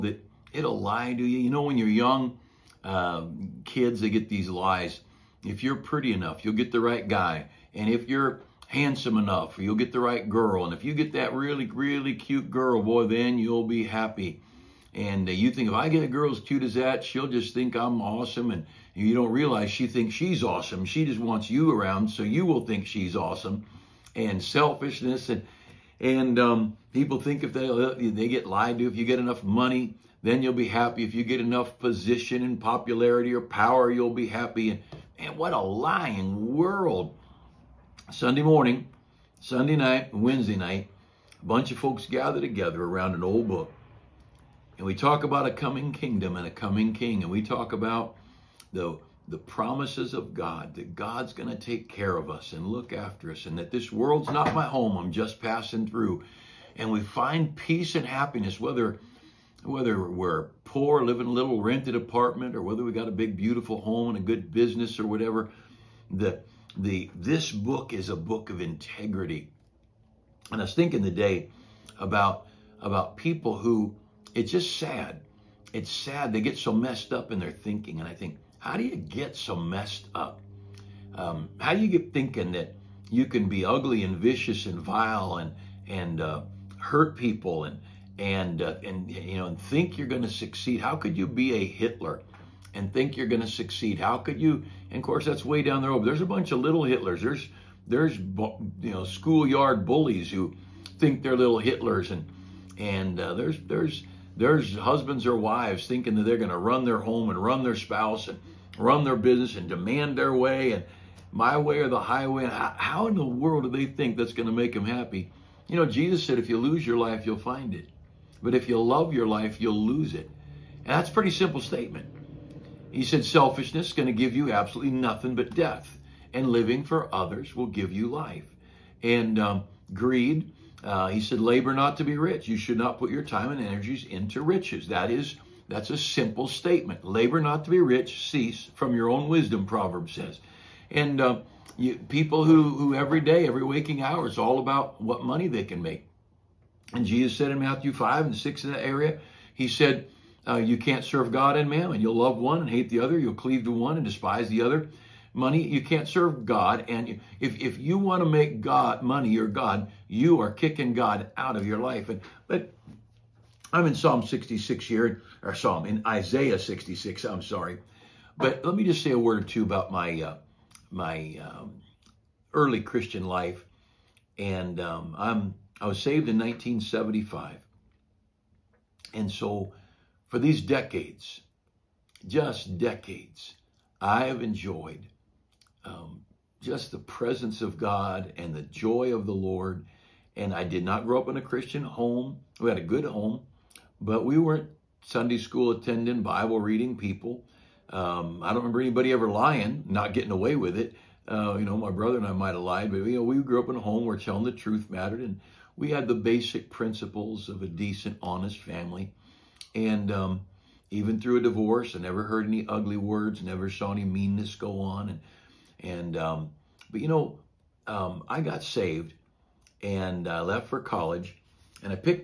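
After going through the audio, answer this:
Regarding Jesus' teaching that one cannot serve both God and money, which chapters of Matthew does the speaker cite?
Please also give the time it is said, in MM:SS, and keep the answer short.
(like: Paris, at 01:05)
5 and 6, at 02:27.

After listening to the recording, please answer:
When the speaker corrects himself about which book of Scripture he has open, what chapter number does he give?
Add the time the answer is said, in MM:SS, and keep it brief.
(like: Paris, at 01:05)
66, at 02:46.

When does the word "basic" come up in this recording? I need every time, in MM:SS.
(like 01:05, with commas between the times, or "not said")
03:26.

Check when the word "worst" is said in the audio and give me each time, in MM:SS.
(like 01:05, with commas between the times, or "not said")
not said.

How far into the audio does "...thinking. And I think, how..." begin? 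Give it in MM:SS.
01:17.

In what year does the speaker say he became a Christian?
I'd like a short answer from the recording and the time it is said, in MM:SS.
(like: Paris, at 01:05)
1975, at 02:56.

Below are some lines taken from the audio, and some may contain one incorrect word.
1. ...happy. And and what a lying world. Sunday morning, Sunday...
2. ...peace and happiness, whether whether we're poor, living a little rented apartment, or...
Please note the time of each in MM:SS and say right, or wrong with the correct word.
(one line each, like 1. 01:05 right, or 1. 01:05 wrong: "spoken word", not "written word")
1. 00:34 right
2. 00:57 right.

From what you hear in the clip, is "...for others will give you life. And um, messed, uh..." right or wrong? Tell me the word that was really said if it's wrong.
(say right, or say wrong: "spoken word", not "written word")
wrong: "greed", not "messed".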